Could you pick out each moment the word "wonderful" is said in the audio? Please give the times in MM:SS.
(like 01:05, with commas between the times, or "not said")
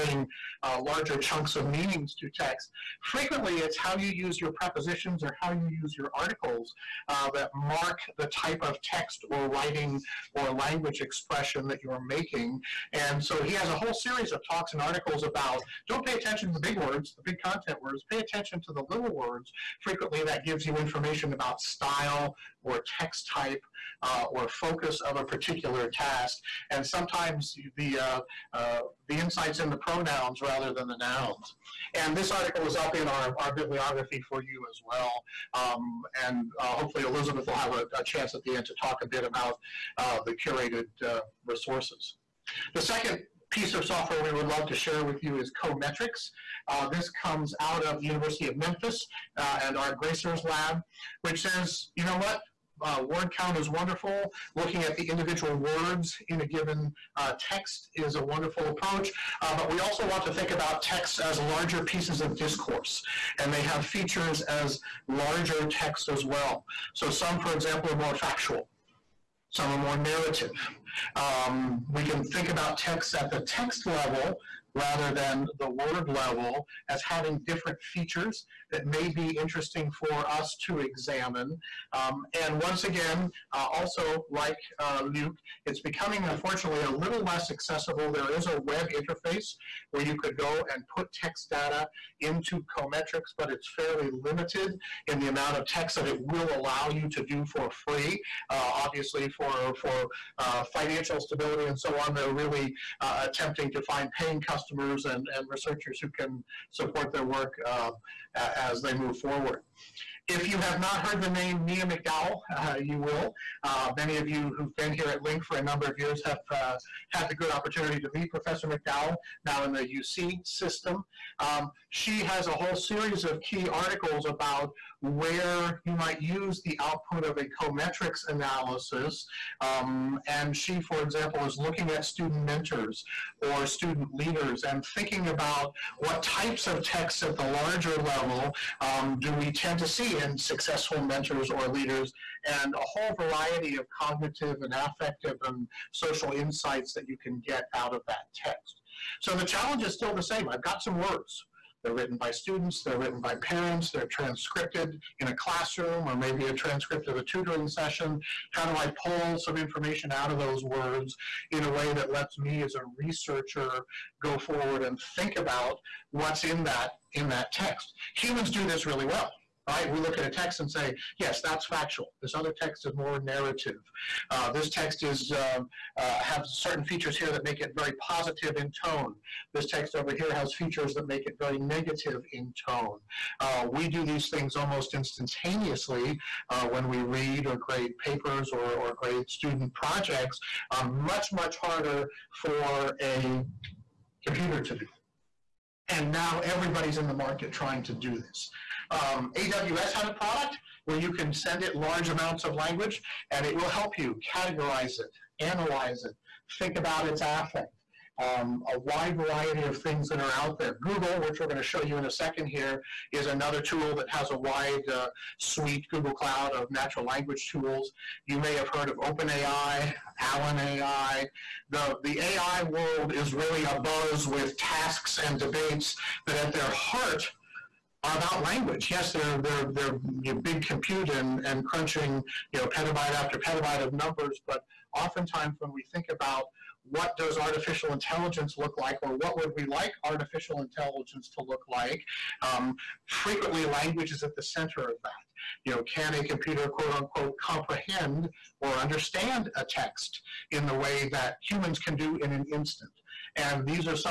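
00:53, 00:58.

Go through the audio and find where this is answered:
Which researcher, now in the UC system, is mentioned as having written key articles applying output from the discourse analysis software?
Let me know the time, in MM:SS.
01:51.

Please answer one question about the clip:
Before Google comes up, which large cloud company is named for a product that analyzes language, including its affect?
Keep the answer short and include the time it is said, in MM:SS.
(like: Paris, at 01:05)
AWS, at 03:19.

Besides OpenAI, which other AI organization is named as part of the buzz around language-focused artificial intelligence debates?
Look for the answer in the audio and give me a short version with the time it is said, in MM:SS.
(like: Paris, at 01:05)
Allen AI, at 03:40.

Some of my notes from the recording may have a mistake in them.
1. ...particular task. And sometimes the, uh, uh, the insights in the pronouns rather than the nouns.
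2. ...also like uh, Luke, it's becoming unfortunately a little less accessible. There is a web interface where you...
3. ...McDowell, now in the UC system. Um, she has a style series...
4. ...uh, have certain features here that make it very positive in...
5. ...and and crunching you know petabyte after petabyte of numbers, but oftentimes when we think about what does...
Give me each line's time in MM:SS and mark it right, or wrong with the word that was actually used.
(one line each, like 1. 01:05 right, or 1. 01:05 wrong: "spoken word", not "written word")
1. 00:25 right
2. 01:23 right
3. 01:58 wrong: "whole", not "style"
4. 02:55 right
5. 03:51 right.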